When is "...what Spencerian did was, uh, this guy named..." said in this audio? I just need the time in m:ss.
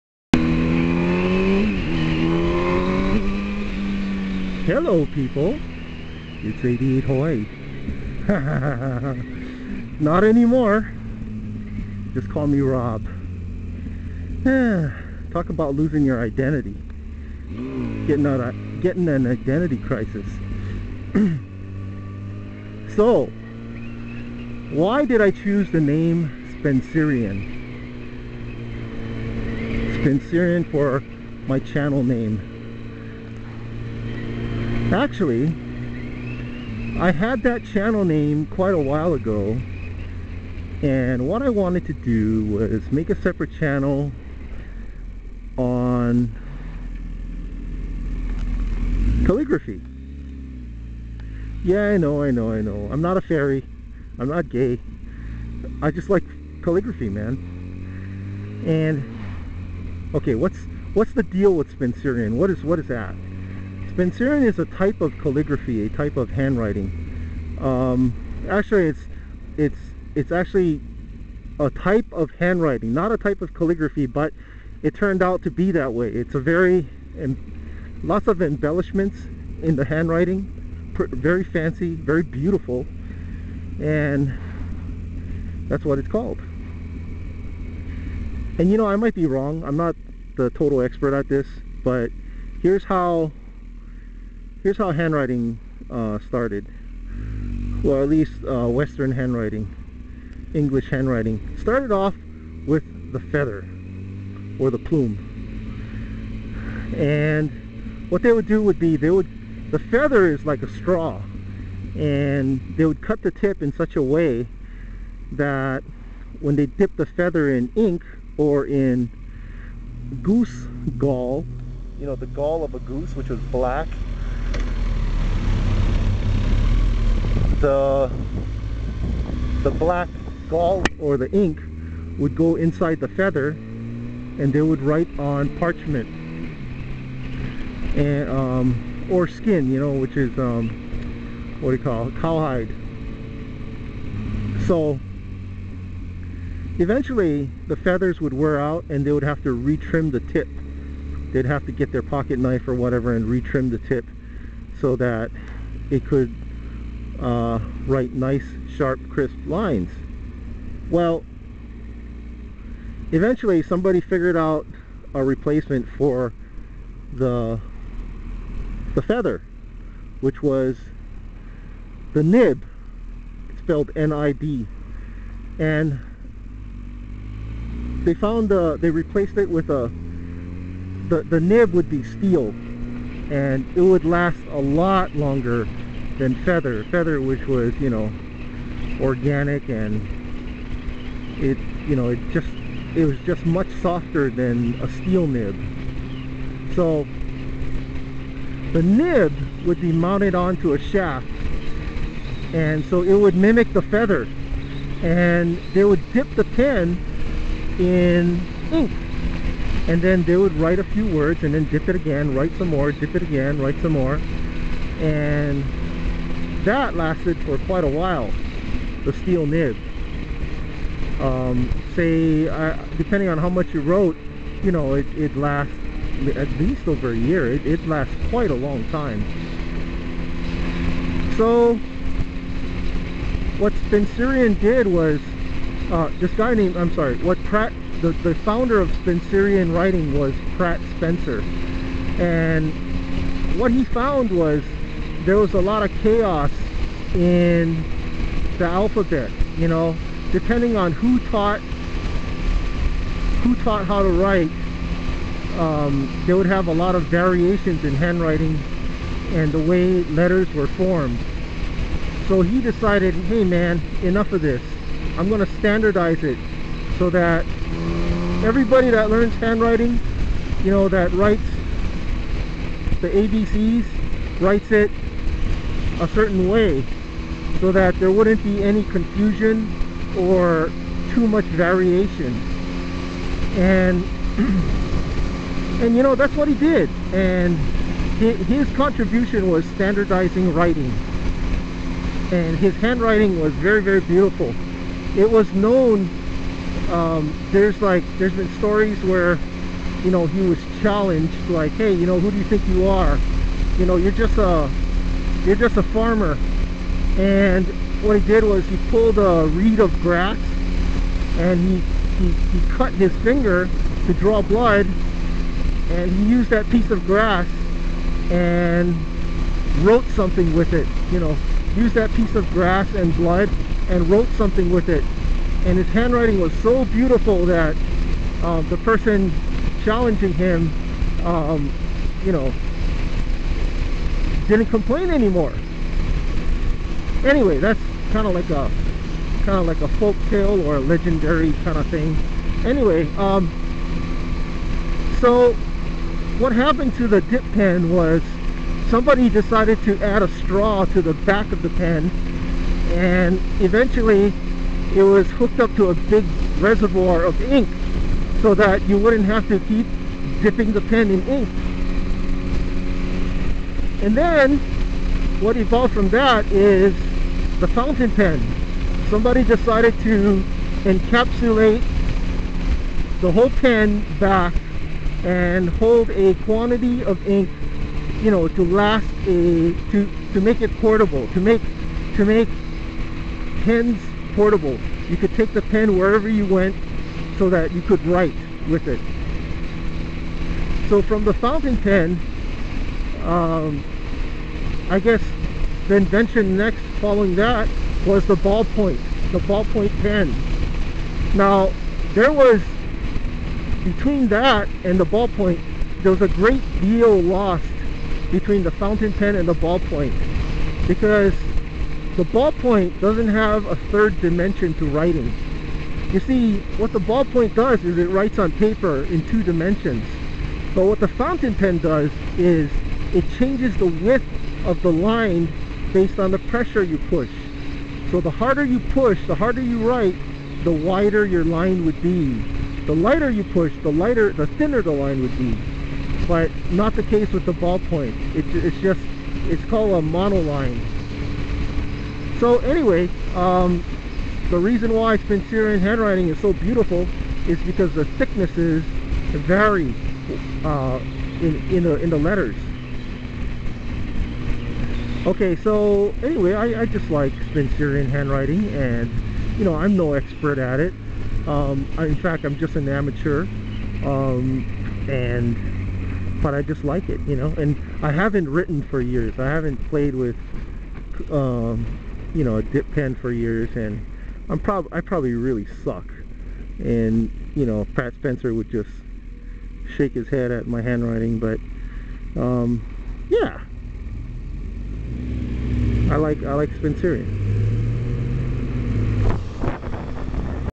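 3:53.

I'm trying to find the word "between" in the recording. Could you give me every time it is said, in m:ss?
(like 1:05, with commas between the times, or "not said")
6:43, 6:48.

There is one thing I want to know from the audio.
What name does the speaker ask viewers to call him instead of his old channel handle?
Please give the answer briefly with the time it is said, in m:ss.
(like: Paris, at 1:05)
Rob, at 0:12.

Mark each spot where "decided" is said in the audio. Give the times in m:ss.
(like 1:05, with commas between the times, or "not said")
4:22, 5:49, 6:09.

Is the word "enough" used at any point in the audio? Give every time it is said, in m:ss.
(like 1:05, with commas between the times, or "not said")
4:24.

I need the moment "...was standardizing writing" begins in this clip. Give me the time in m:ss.
4:49.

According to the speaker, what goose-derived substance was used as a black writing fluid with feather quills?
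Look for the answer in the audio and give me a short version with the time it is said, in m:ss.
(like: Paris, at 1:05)
goose gall, at 2:00.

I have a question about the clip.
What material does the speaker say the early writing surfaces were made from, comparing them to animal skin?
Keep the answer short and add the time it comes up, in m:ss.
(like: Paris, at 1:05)
cowhide, at 2:22.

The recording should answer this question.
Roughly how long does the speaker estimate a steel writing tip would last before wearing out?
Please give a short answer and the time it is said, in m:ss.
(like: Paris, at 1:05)
over a year, at 3:46.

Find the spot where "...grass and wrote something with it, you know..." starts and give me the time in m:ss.
5:17.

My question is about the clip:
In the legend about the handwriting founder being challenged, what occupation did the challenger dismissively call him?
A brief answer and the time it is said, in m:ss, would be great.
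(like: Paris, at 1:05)
farmer, at 5:05.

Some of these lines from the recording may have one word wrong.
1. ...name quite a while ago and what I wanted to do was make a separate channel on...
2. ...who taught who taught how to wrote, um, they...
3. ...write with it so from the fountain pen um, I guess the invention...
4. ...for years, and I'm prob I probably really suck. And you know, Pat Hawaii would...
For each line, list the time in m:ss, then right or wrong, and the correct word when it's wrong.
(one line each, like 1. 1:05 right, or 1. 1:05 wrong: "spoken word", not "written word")
1. 0:38 right
2. 4:10 wrong: "write", not "wrote"
3. 6:28 right
4. 7:53 wrong: "Spencer", not "Hawaii".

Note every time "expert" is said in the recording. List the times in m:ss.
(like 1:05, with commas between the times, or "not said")
1:30, 7:40.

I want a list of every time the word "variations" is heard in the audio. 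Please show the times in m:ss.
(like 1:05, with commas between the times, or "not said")
4:17, 4:41.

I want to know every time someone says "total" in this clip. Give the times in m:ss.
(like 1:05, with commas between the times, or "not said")
1:30.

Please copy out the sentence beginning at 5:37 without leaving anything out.
Anyway, that's kind of like a kind of like a folk tale or a legendary kind of thing.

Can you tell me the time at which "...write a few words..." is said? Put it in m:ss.
3:30.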